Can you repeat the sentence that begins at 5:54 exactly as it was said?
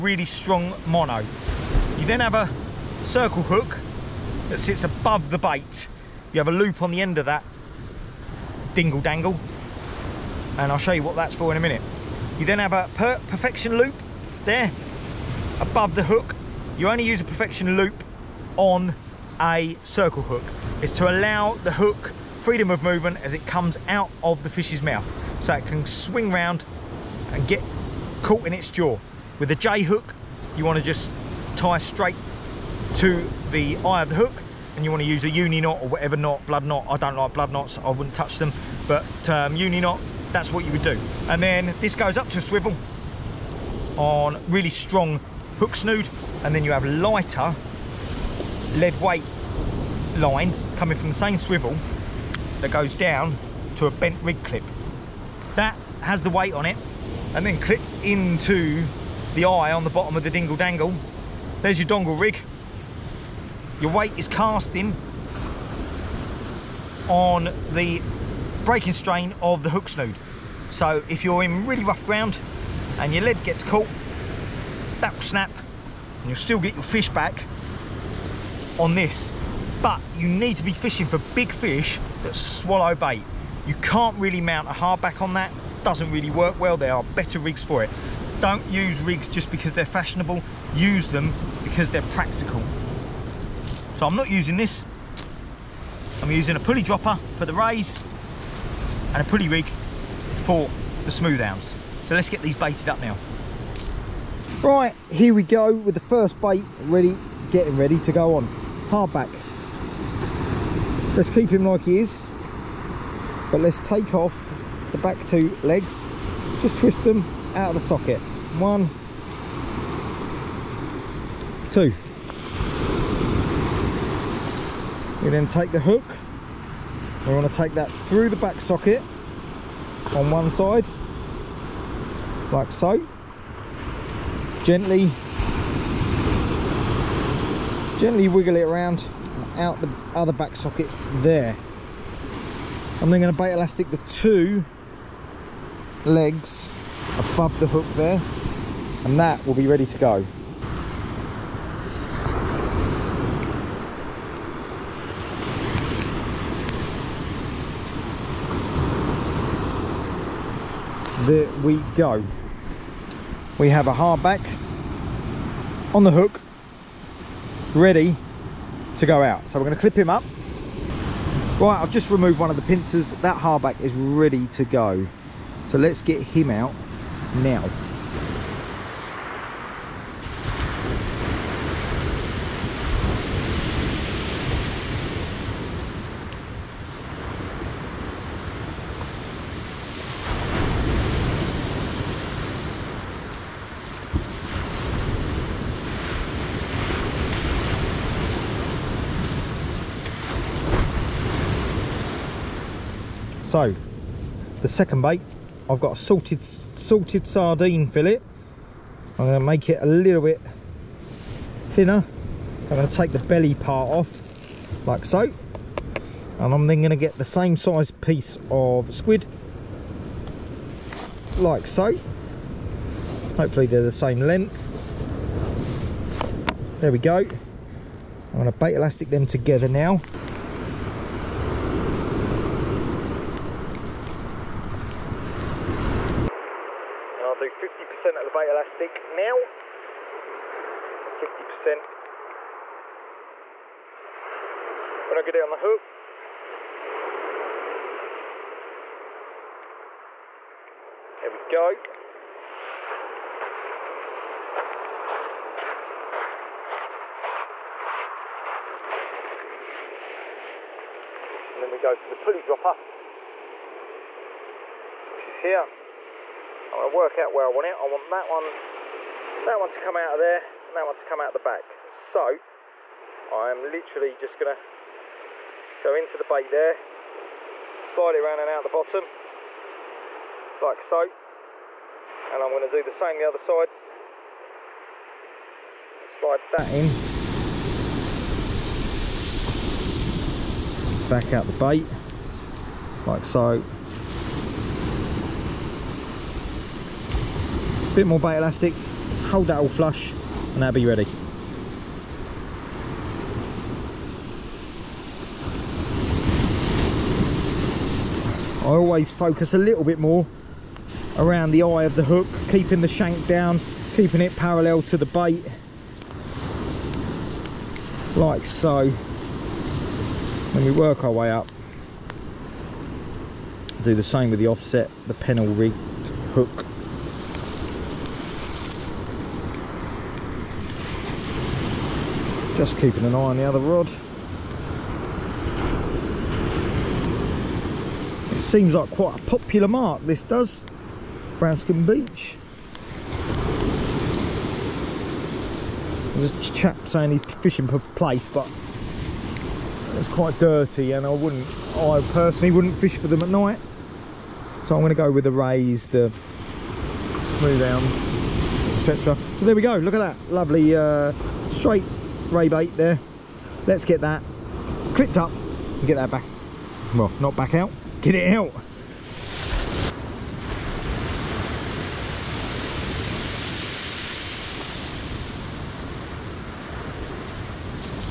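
So I'm gonna go with the rays, the smooth hounds etc.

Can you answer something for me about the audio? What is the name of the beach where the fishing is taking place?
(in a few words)
Branscombe Beach.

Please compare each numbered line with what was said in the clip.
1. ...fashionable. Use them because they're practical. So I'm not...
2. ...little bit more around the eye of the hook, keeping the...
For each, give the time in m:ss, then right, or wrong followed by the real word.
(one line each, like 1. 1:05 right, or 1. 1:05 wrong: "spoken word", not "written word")
1. 1:29 right
2. 5:09 right.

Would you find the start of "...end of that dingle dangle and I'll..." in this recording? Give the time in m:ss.
0:07.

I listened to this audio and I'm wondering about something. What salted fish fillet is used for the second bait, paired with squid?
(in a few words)
Sardine.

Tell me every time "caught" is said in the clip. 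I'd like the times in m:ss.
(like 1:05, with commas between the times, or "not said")
0:28, 1:13.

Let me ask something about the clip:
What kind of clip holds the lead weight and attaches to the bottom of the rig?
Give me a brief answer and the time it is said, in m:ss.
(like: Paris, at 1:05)
Bent rig clip, at 0:53.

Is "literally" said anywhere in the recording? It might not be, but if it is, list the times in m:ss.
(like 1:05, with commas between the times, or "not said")
4:33.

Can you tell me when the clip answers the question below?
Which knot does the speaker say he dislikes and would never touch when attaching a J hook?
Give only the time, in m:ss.
0:37.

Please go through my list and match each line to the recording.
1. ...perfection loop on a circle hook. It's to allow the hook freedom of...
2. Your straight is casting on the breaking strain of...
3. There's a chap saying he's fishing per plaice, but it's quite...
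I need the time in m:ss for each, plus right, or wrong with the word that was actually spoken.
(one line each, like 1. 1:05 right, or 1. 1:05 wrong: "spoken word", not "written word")
1. 0:17 right
2. 1:03 wrong: "weight", not "straight"
3. 5:46 right.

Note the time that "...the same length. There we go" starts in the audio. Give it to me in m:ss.
3:43.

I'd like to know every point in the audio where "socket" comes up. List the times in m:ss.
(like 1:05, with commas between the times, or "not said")
1:57, 2:08, 2:20.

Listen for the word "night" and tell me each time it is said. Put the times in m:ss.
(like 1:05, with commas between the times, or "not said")
5:53.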